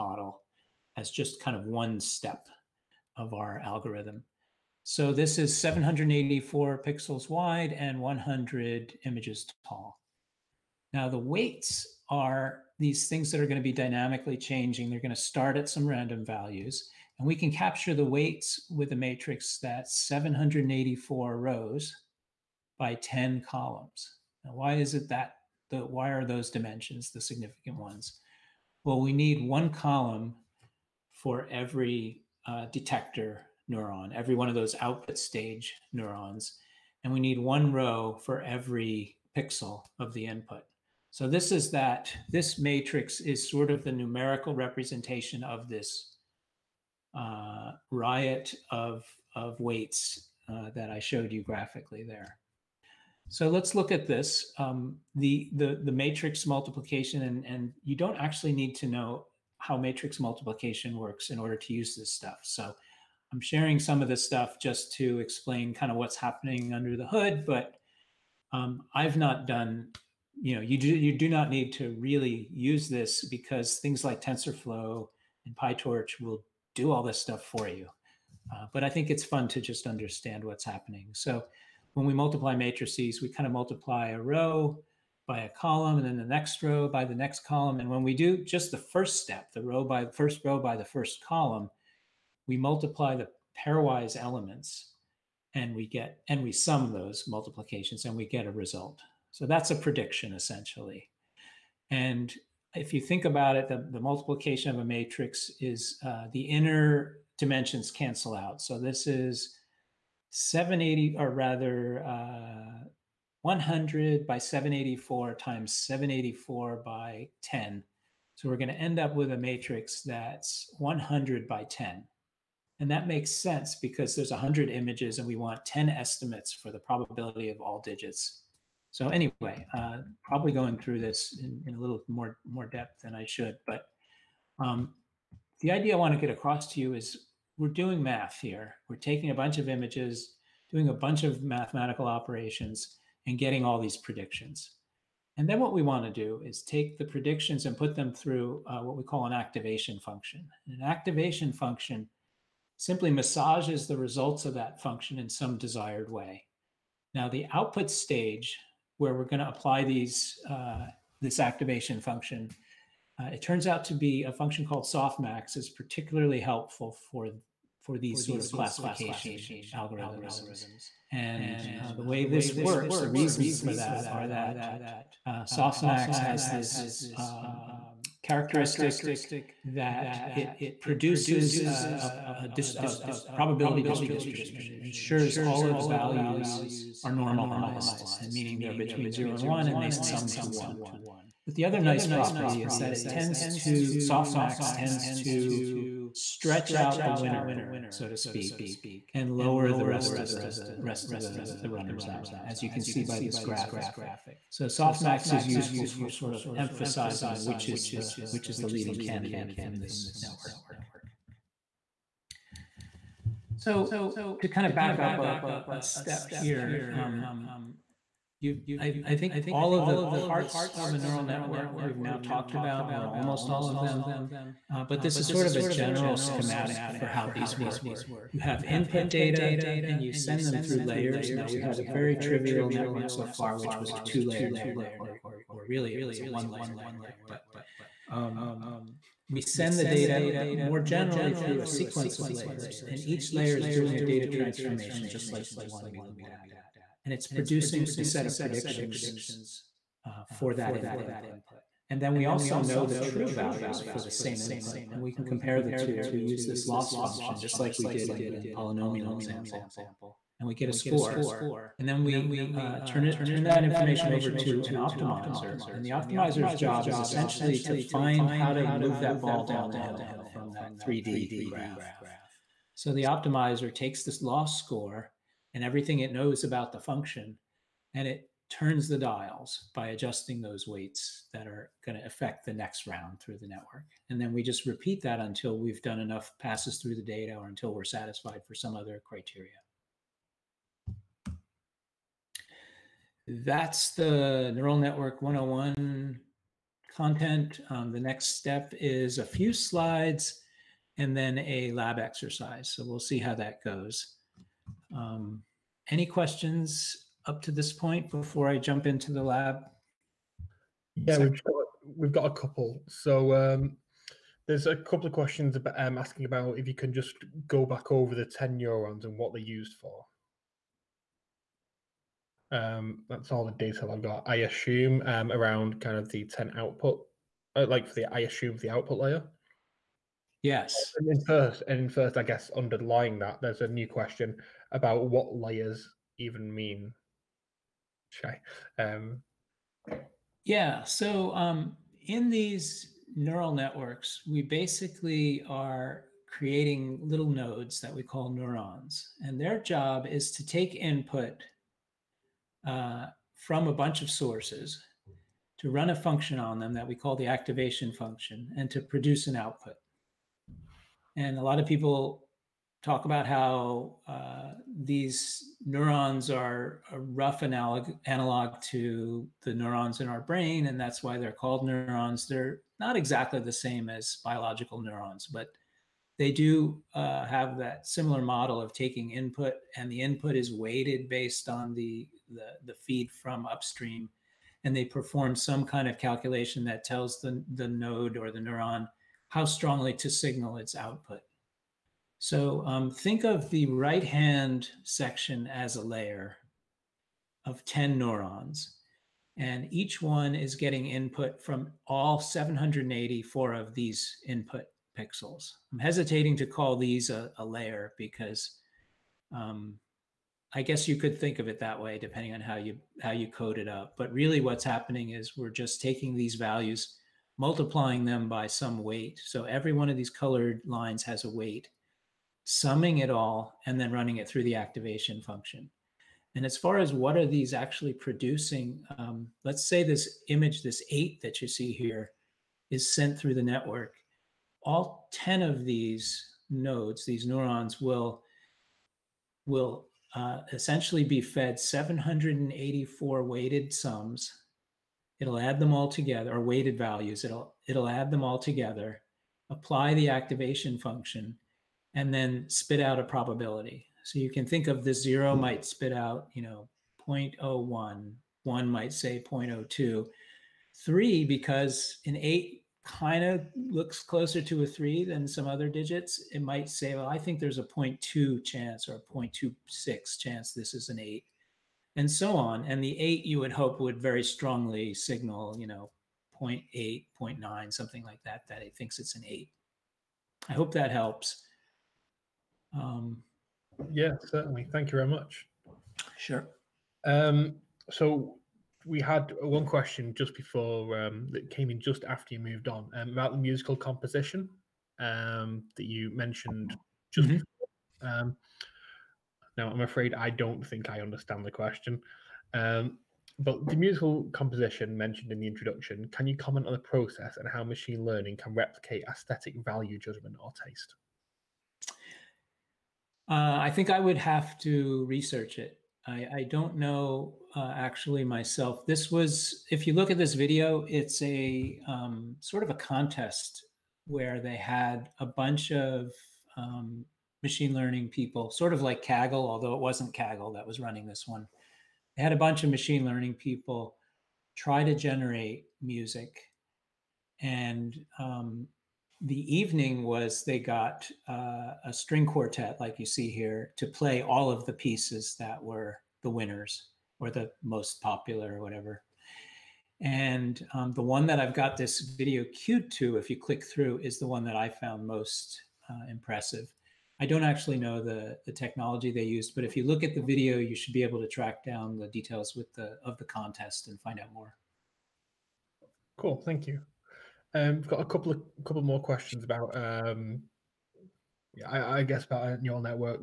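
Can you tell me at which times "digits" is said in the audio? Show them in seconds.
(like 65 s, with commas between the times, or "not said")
127 s, 465 s.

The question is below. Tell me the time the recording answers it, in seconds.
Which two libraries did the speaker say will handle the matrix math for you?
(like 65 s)
74 s.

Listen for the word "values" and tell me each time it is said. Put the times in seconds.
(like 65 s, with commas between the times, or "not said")
16 s, 185 s, 253 s, 416 s, 446 s, 509 s.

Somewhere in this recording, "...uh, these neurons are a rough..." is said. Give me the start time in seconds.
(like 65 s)
364 s.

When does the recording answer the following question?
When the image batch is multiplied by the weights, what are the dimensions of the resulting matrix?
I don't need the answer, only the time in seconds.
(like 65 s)
120 s.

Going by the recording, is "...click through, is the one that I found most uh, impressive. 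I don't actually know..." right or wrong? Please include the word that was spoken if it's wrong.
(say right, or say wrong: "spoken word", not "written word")
right.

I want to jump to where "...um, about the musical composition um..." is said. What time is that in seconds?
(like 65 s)
492 s.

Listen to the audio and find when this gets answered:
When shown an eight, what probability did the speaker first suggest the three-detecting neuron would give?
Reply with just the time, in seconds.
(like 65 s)
467 s.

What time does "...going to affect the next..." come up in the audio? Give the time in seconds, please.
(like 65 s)
281 s.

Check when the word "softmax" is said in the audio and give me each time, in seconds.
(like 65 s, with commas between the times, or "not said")
164 s, 175 s, 193 s, 204 s.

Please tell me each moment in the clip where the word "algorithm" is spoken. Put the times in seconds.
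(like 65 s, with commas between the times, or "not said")
3 s, 169 s.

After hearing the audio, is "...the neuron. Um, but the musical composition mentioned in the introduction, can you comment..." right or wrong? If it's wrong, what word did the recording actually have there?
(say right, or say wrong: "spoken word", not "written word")
wrong: "question", not "neuron".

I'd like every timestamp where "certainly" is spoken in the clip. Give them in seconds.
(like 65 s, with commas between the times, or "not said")
484 s.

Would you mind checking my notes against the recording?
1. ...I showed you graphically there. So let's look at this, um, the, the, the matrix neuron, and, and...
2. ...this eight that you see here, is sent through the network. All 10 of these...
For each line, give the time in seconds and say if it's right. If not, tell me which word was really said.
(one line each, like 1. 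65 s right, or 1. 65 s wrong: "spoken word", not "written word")
1. 50 s wrong: "multiplication", not "neuron"
2. 430 s right.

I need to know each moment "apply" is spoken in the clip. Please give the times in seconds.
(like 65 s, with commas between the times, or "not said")
159 s, 449 s.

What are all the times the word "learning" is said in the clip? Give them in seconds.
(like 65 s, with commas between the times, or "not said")
508 s, 527 s, 533 s.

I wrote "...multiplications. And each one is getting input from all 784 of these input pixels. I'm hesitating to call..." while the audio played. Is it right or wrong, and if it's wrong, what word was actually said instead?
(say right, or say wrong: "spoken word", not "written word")
wrong: "neurons", not "multiplications".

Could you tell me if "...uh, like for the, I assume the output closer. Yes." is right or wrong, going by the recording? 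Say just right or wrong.
wrong.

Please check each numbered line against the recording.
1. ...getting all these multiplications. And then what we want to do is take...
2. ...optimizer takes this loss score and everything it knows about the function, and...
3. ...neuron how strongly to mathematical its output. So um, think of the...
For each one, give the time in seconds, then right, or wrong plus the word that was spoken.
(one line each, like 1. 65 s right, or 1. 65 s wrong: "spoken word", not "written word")
1. 143 s wrong: "predictions", not "multiplications"
2. 273 s right
3. 388 s wrong: "signal", not "mathematical".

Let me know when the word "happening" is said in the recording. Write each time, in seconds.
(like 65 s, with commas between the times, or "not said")
66 s, 80 s, 414 s.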